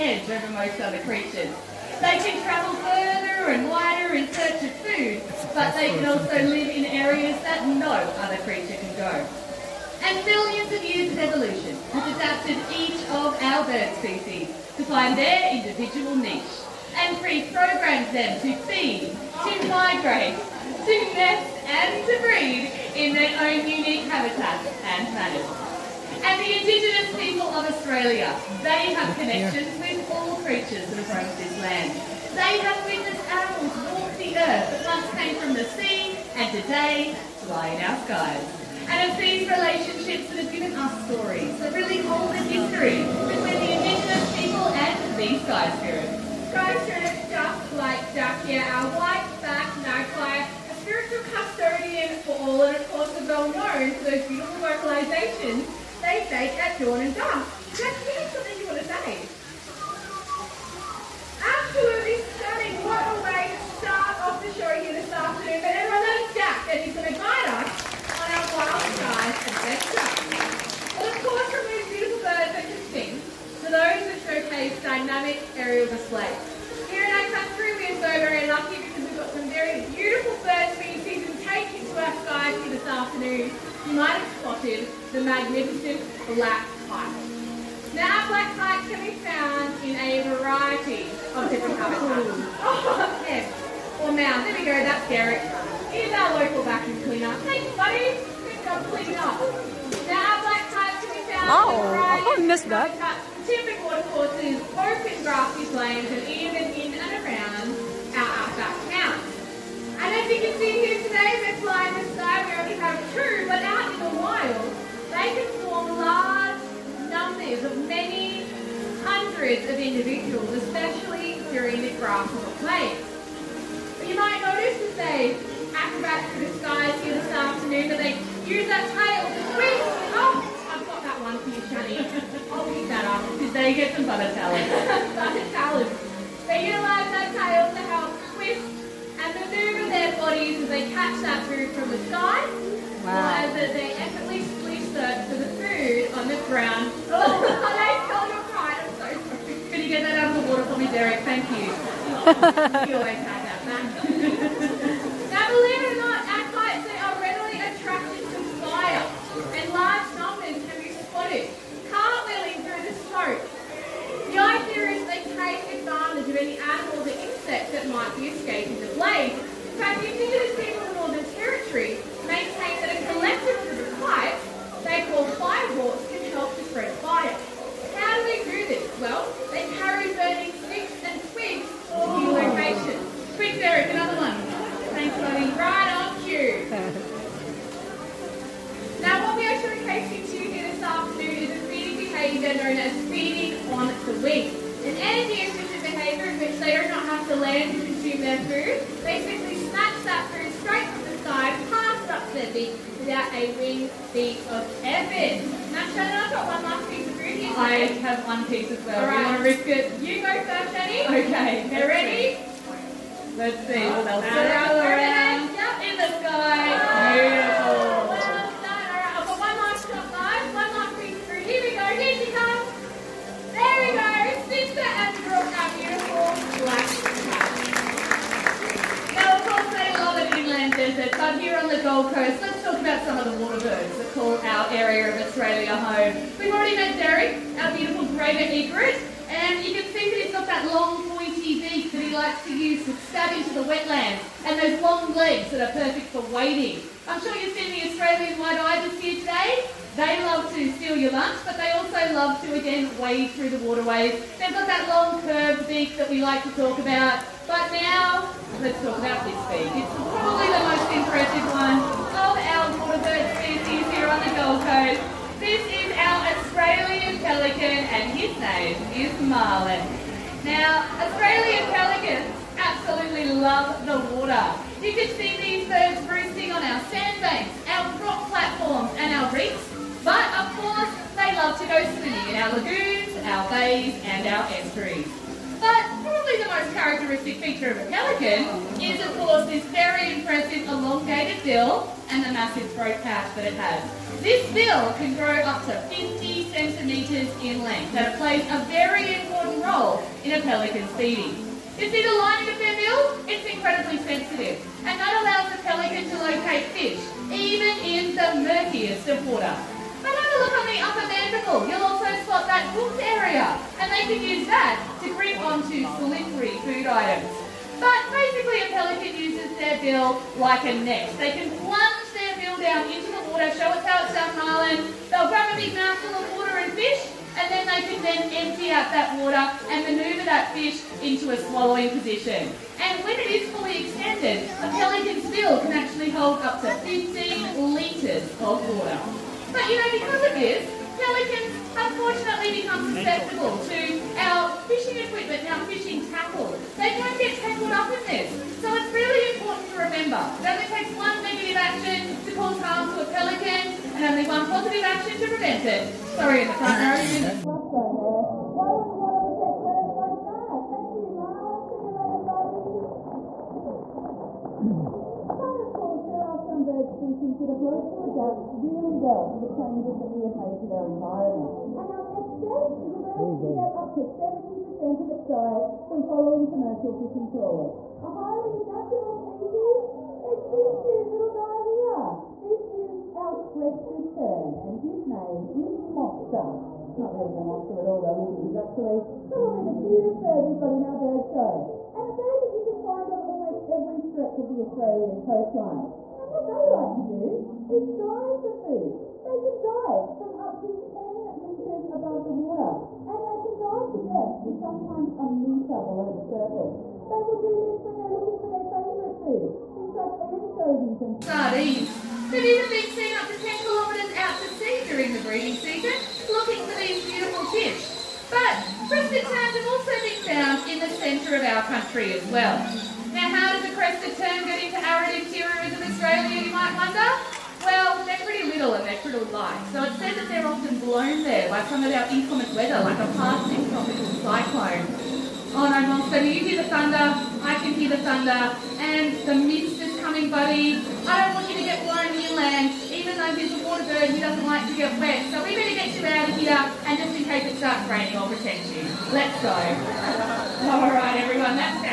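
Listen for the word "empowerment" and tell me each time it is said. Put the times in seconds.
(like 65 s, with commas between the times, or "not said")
not said.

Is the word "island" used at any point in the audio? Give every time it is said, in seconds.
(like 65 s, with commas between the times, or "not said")
324 s.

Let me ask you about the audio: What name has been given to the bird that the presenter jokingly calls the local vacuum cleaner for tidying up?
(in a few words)
Derek.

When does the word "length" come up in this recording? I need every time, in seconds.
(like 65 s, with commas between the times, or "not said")
297 s.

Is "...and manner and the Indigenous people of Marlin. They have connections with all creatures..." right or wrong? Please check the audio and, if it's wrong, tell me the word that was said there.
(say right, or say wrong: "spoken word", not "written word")
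wrong: "Australia", not "Marlin".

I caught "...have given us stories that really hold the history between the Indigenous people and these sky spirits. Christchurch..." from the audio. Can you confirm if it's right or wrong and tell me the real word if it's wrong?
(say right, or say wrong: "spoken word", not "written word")
right.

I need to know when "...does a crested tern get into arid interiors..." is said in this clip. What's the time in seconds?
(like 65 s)
423 s.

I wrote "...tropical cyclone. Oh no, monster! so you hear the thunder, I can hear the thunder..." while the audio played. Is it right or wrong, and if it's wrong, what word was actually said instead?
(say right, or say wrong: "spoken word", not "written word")
right.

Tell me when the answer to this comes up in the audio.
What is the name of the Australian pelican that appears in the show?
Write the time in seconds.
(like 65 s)
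269 s.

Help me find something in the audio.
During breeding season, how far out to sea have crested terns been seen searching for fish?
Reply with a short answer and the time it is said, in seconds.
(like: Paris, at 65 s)
10 kilometres, at 413 s.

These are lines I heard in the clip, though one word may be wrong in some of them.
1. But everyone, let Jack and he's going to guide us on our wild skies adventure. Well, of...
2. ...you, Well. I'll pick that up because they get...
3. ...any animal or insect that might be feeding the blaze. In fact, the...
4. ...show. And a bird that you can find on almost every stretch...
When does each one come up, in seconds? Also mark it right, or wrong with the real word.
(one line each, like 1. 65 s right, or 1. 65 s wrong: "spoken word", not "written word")
1. 65 s right
2. 131 s wrong: "Shani", not "Well"
3. 166 s wrong: "escaping", not "feeding"
4. 391 s right.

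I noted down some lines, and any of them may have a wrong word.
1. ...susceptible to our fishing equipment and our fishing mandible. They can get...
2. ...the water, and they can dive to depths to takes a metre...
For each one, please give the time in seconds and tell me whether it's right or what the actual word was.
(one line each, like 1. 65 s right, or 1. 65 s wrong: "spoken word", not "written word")
1. 342 s wrong: "tackle", not "mandible"
2. 402 s wrong: "sometimes", not "takes".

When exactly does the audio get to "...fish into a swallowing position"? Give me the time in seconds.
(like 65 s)
330 s.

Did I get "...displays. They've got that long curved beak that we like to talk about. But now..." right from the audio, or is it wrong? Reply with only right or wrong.
wrong.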